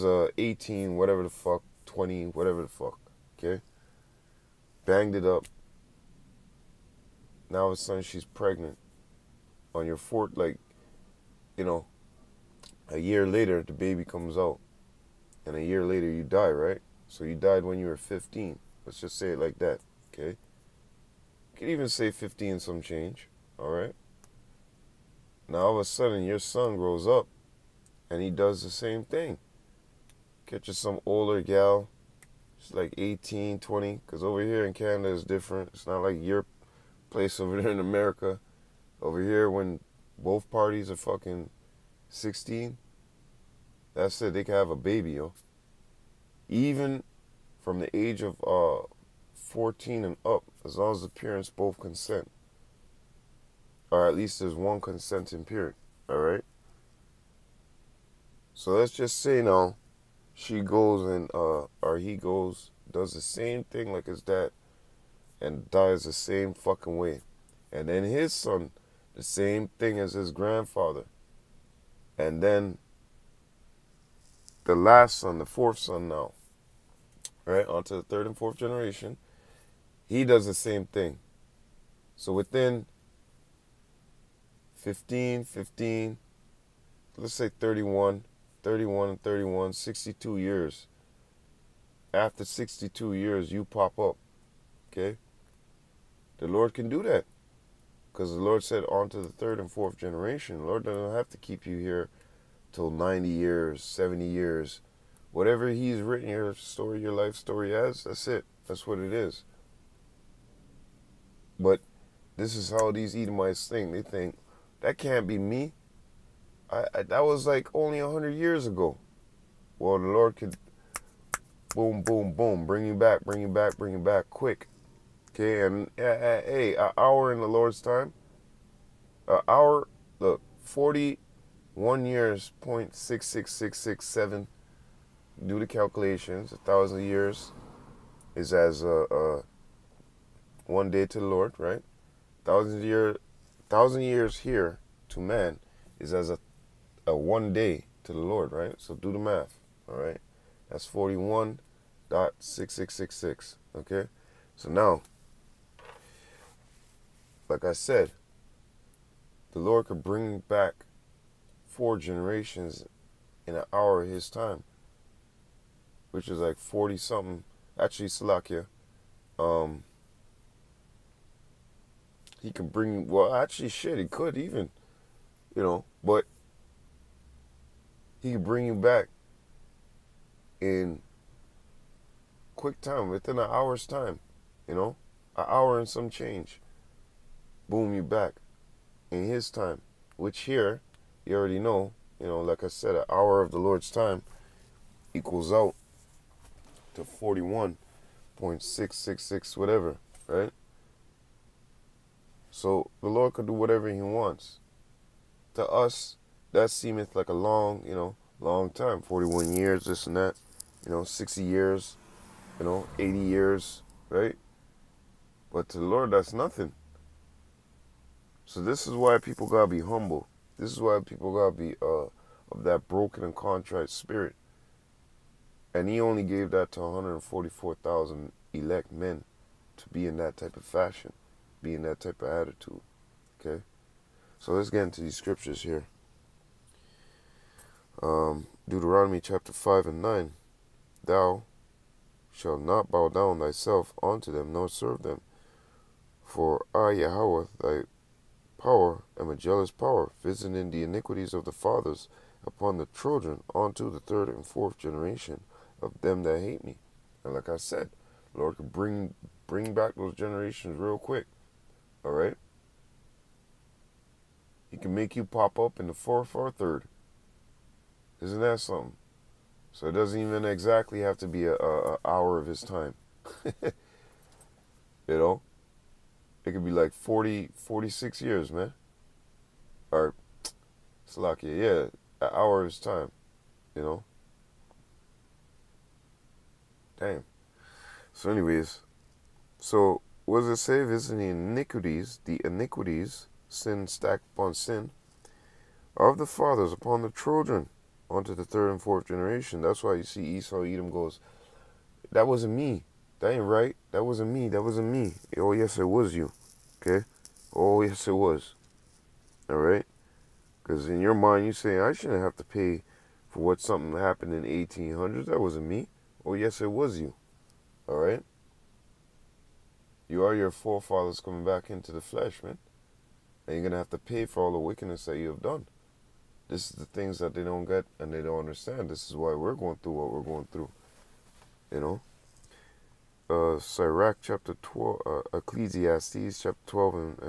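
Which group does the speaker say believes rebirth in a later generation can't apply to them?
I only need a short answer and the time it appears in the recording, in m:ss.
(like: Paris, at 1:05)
Edomites, at 1:53.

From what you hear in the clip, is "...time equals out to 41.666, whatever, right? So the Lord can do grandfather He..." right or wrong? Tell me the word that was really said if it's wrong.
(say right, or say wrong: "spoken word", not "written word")
wrong: "whatever", not "grandfather".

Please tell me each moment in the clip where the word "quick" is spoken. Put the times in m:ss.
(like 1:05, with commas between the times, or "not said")
2:04, 3:02, 4:20.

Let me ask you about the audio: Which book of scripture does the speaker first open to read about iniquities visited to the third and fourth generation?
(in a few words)
Deuteronomy.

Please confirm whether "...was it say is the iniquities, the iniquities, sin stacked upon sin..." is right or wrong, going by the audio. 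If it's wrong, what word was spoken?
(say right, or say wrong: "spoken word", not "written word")
right.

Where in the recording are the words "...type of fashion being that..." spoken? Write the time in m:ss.
3:50.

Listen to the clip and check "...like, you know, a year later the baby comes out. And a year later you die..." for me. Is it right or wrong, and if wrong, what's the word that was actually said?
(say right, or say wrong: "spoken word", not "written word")
right.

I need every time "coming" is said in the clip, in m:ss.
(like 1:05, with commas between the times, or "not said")
5:21.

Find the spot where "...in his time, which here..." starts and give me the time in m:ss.
3:09.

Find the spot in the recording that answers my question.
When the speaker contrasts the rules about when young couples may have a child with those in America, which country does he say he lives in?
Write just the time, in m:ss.
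0:34.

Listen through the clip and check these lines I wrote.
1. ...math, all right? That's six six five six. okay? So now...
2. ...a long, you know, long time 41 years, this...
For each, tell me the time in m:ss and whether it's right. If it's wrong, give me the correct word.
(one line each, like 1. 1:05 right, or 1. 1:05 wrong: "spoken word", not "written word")
1. 2:29 wrong: "six", not "five"
2. 3:27 right.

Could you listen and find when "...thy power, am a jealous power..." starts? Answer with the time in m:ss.
4:07.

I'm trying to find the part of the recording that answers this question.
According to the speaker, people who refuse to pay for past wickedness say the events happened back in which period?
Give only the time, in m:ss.
5:14.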